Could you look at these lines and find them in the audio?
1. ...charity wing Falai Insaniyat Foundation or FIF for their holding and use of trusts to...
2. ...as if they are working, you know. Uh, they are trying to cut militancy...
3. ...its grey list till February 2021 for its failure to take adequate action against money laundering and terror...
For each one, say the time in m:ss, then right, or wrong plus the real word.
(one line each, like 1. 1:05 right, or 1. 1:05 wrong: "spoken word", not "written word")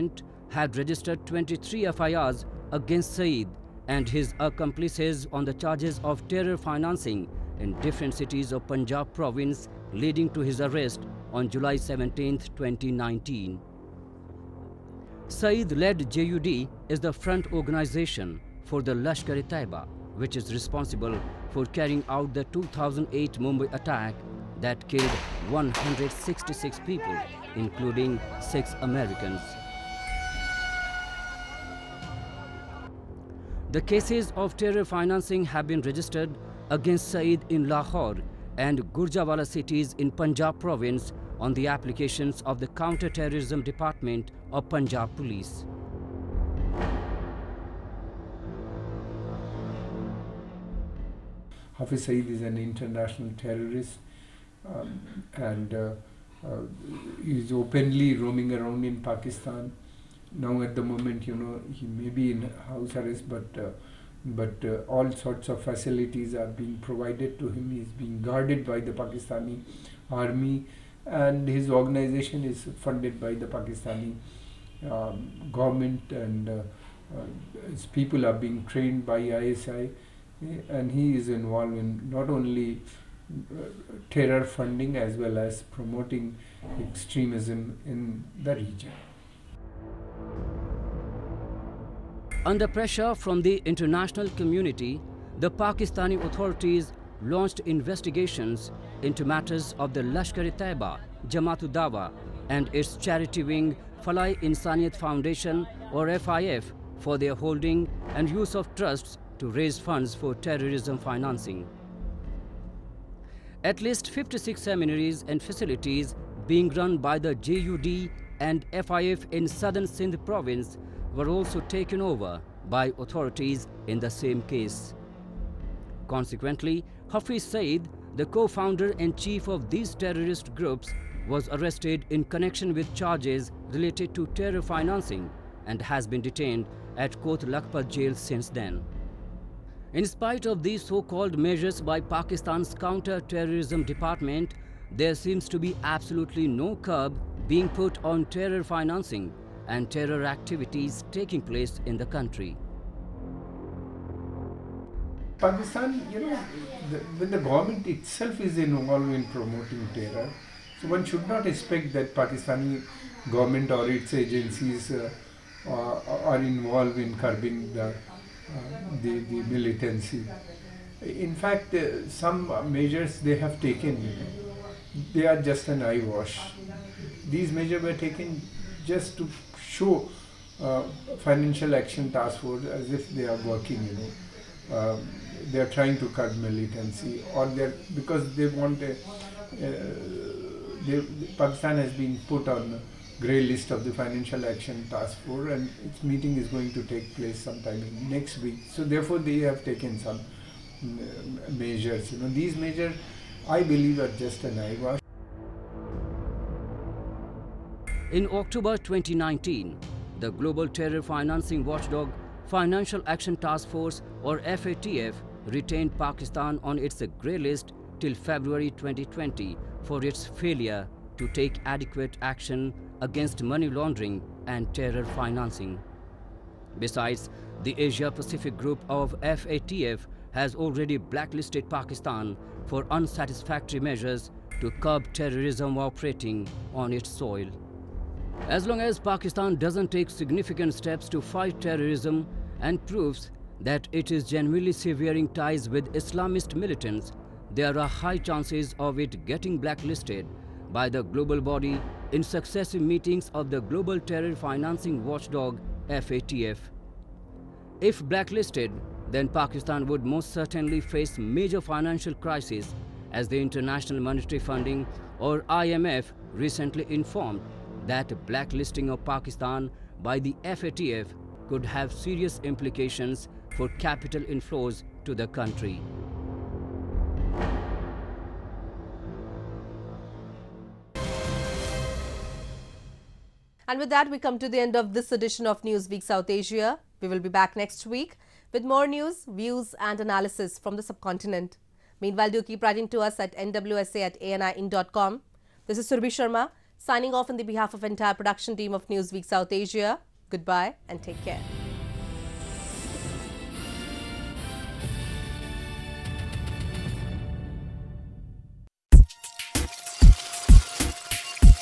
1. 1:42 right
2. 3:02 right
3. 3:36 wrong: "2020", not "2021".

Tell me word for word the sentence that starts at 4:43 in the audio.
And with that, we come to the end of this edition of Newsweek South Asia.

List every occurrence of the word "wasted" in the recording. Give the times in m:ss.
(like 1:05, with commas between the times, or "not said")
not said.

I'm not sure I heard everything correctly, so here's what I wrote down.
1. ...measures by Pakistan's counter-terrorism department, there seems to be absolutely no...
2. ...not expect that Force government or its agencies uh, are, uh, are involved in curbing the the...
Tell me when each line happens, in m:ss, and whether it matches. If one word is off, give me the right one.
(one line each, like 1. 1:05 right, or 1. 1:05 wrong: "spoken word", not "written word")
1. 2:21 right
2. 2:41 wrong: "Pakistani", not "Force".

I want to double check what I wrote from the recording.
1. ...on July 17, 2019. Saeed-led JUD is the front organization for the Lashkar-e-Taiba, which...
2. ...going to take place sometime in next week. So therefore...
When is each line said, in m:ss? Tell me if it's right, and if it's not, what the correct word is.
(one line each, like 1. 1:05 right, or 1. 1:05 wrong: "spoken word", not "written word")
1. 0:11 right
2. 3:16 right.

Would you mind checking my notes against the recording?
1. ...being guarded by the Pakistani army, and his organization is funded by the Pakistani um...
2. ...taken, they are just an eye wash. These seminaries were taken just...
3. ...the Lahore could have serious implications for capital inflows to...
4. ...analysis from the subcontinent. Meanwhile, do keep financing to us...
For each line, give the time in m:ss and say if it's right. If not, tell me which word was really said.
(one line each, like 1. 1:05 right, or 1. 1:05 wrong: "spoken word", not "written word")
1. 1:07 right
2. 2:53 wrong: "measures", not "seminaries"
3. 4:30 wrong: "FATF", not "Lahore"
4. 4:49 wrong: "writing", not "financing".